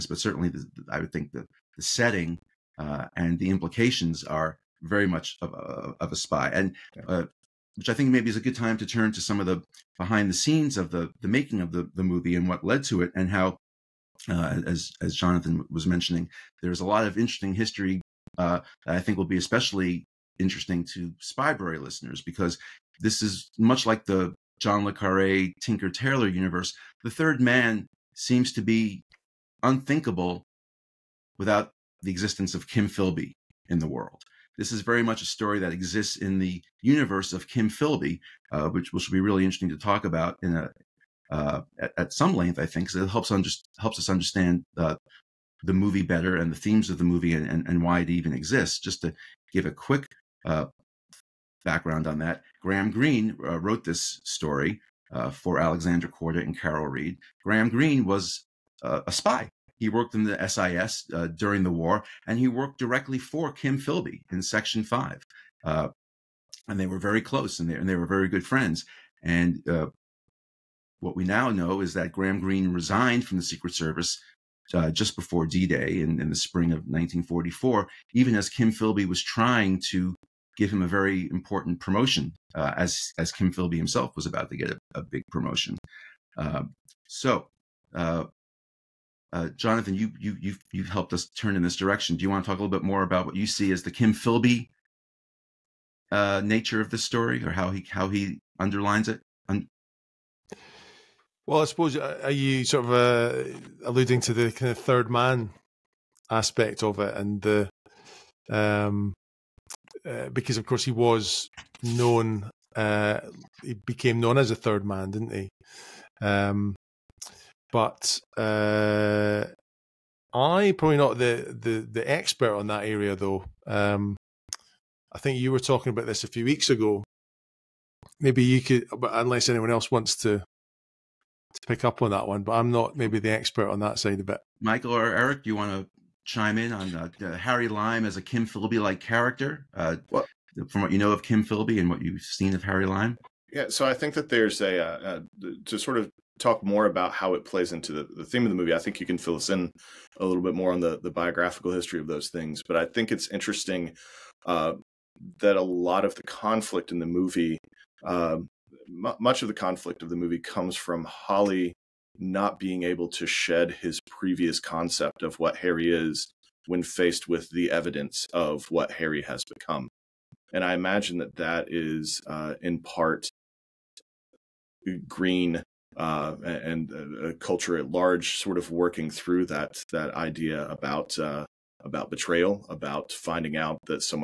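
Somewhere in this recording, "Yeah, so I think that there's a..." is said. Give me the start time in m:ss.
2:23.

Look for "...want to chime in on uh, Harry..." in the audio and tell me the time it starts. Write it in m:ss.
2:15.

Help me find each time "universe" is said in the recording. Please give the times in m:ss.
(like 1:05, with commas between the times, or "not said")
0:26, 0:36.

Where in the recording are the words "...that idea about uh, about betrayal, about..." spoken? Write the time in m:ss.
2:59.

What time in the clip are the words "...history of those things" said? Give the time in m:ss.
2:31.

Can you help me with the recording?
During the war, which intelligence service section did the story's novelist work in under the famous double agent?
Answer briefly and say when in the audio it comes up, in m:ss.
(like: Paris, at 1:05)
Section 5, at 1:04.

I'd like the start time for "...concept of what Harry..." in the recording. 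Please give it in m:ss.
2:44.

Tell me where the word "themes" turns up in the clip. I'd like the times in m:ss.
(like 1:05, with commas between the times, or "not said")
0:46, 2:28.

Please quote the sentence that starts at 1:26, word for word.
Uh, so, uh, uh, Jonathan, you you you've you've helped us turn in this direction.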